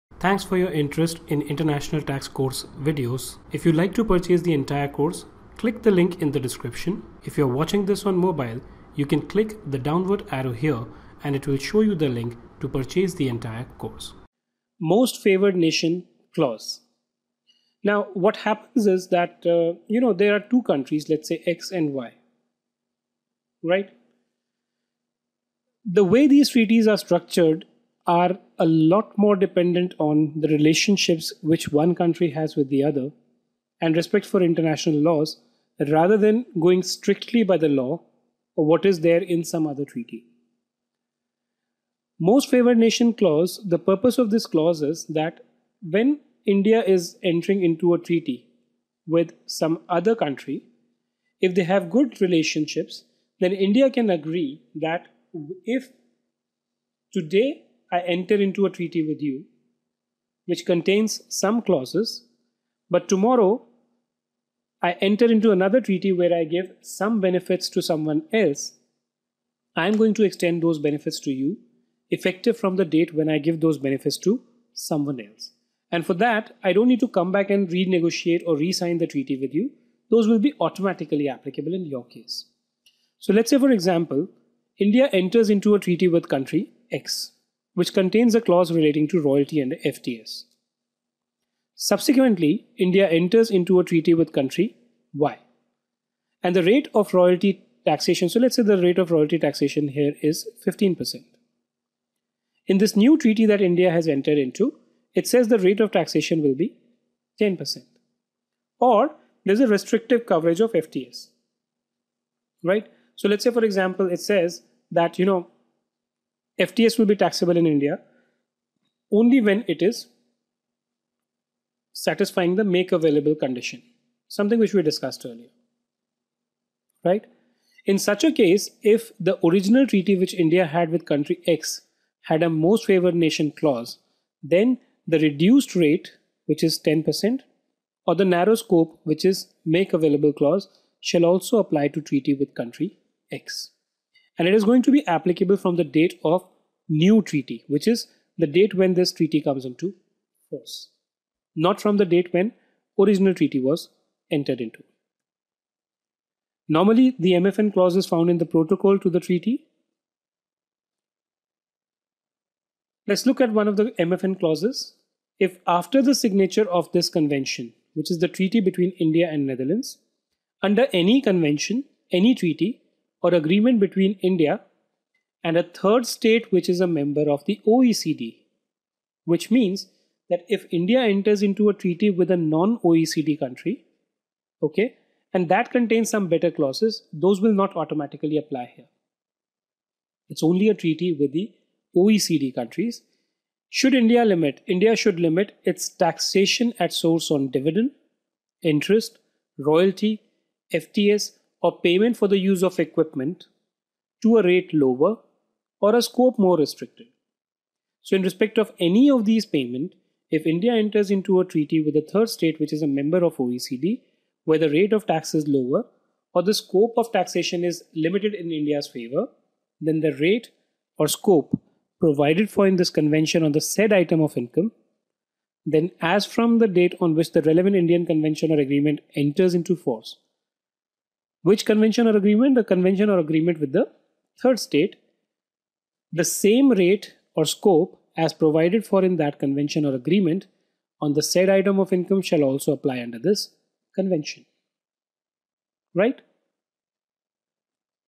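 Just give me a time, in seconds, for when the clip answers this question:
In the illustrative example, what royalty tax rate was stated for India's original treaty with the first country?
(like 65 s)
100 s.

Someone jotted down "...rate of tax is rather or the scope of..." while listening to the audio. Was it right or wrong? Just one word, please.
wrong.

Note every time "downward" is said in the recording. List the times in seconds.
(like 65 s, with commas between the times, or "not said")
9 s.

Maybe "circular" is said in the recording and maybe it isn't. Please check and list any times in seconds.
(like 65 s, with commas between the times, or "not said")
not said.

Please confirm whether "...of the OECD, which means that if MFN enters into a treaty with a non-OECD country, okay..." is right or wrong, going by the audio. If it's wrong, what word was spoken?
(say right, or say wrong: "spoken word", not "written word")
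wrong: "India", not "MFN".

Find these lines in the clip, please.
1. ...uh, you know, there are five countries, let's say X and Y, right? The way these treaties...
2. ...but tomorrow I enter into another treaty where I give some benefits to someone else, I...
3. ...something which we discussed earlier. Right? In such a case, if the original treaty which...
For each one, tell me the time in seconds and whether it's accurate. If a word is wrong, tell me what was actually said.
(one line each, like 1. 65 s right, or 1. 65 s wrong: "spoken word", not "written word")
1. 19 s wrong: "two", not "five"
2. 62 s right
3. 124 s right.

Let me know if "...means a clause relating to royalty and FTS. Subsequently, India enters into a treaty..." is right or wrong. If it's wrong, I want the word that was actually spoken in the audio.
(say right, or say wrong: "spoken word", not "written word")
wrong: "contains", not "means".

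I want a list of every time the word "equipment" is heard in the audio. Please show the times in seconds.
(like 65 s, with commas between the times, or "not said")
202 s.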